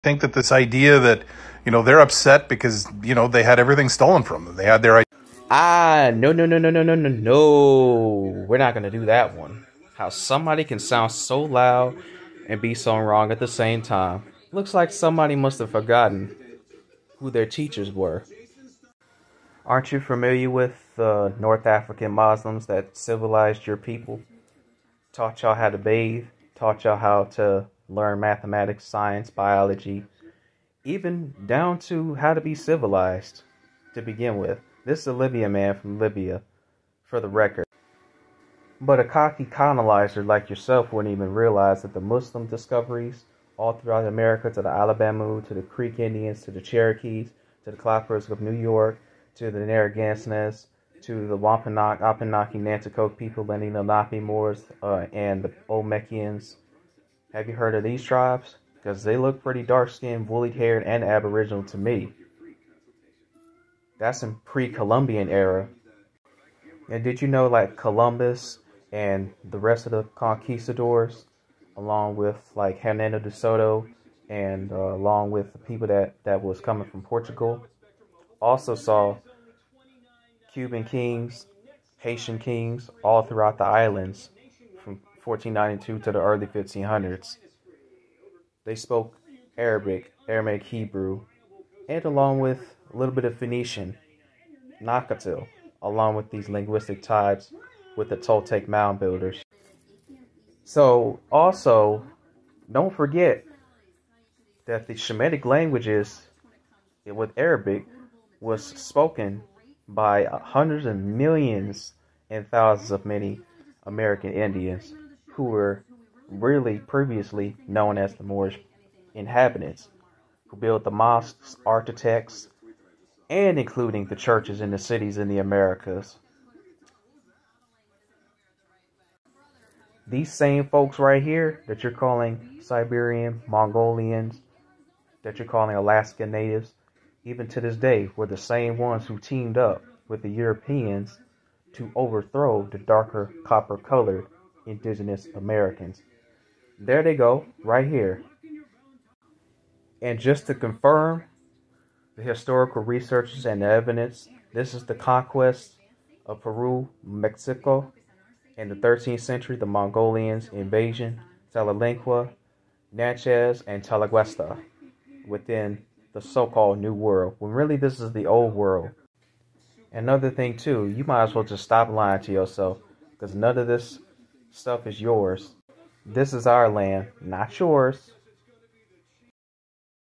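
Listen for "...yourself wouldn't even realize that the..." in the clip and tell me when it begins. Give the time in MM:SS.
00:40.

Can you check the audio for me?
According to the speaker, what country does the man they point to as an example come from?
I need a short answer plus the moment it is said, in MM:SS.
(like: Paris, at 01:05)
Libya, at 00:35.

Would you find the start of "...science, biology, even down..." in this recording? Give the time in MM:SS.
00:28.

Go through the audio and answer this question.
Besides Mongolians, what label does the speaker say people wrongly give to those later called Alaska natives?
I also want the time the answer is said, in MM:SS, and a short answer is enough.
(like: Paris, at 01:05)
Siberian, at 02:12.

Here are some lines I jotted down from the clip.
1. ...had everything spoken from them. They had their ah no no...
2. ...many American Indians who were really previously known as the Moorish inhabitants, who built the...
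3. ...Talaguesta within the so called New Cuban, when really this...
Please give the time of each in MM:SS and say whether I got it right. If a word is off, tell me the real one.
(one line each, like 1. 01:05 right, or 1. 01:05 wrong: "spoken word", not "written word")
1. 00:03 wrong: "stolen", not "spoken"
2. 01:53 right
3. 02:43 wrong: "World", not "Cuban".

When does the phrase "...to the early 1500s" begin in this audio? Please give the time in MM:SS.
01:26.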